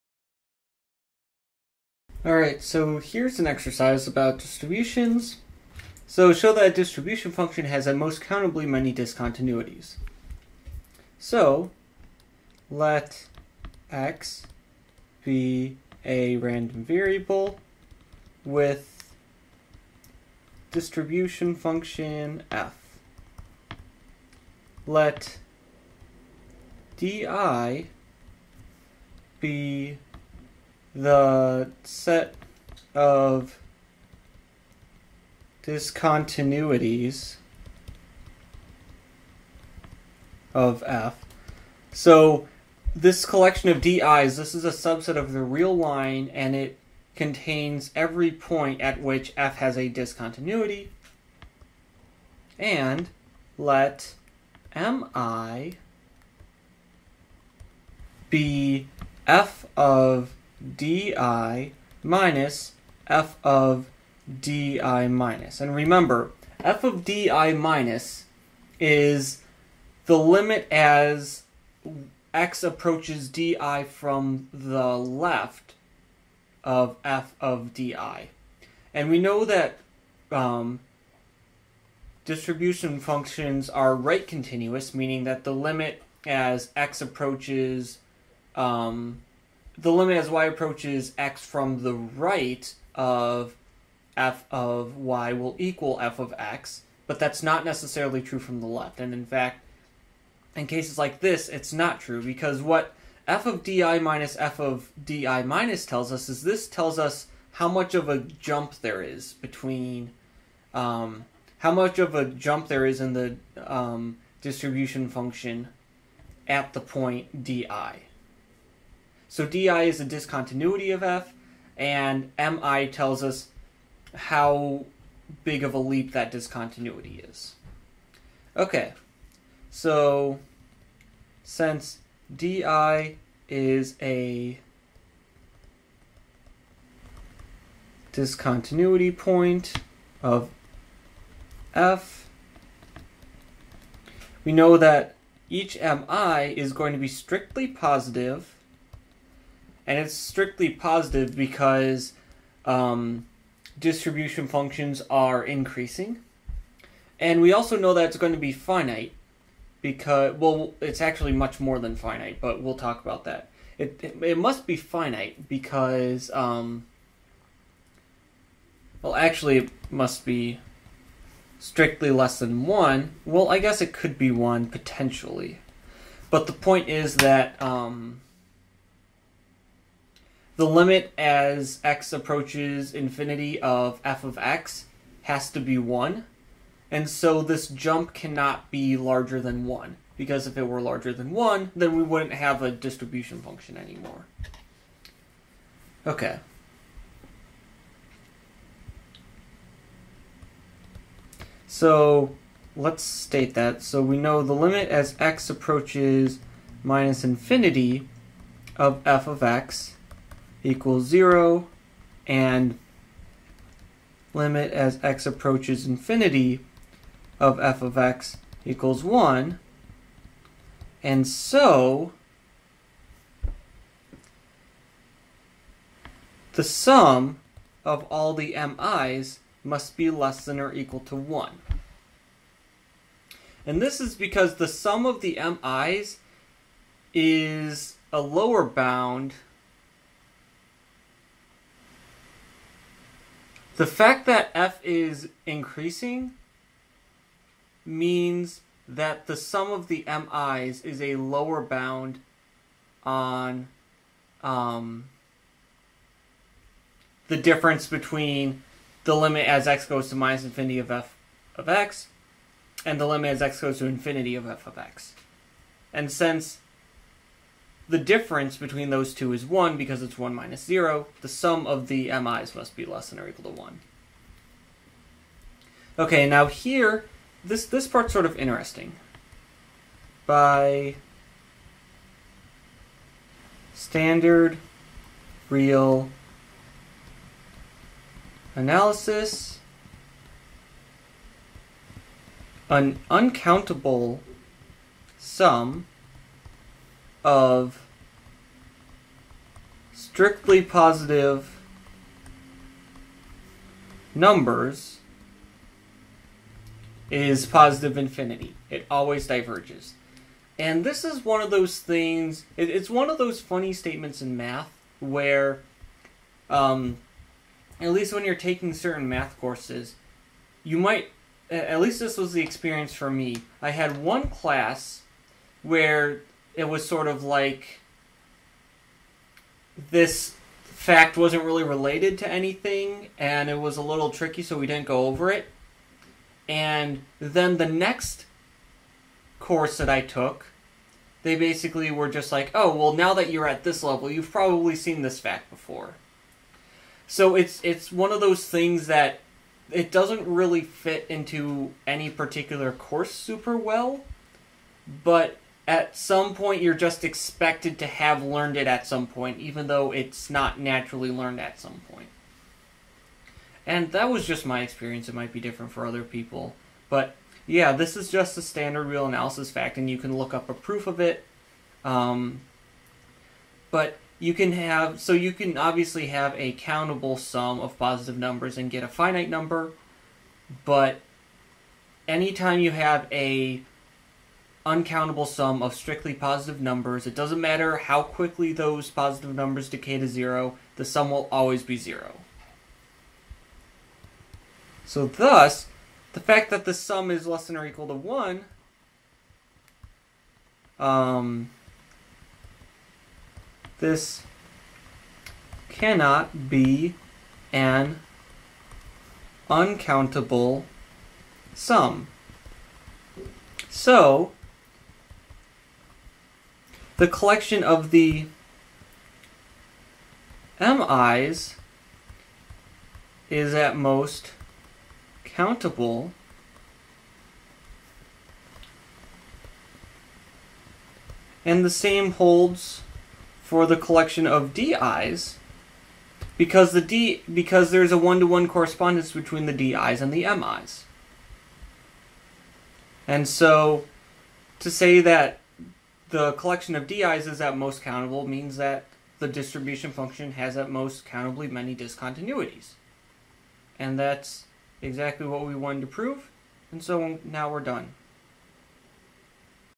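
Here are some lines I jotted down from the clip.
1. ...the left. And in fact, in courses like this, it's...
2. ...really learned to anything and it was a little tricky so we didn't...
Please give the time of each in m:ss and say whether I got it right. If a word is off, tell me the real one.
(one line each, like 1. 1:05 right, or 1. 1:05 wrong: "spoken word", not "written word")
1. 1:38 wrong: "cases", not "courses"
2. 5:31 wrong: "related", not "learned".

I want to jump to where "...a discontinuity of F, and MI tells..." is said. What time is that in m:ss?
2:00.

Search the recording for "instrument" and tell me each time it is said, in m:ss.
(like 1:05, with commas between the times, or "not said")
not said.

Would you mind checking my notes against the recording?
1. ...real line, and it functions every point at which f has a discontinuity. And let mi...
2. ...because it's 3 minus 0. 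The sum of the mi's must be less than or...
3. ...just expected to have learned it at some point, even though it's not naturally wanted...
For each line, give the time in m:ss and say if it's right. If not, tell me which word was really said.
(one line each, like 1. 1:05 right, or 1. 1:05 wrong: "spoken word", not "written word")
1. 0:45 wrong: "contains", not "functions"
2. 4:29 wrong: "1", not "3"
3. 5:56 wrong: "learned", not "wanted".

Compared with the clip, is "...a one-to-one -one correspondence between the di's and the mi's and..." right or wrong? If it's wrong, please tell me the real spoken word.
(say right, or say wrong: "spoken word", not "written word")
right.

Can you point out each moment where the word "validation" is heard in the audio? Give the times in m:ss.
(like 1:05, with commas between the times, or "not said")
not said.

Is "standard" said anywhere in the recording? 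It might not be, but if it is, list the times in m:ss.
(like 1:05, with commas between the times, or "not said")
4:43, 6:08.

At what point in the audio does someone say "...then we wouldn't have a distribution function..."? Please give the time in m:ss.
3:11.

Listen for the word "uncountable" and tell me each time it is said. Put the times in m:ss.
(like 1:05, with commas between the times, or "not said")
4:53, 6:24, 6:49.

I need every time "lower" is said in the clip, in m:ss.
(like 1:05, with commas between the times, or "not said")
3:58, 4:11.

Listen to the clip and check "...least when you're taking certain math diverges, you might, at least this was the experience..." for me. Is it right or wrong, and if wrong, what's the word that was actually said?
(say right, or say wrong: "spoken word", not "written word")
wrong: "courses", not "diverges".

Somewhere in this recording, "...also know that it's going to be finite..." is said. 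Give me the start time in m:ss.
2:37.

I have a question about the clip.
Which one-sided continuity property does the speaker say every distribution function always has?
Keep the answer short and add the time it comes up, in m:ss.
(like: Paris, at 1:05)
right continuous, at 1:23.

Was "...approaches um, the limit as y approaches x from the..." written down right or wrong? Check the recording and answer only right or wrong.
right.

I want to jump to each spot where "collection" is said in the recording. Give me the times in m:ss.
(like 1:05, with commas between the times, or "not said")
0:43, 6:57, 7:13, 7:26.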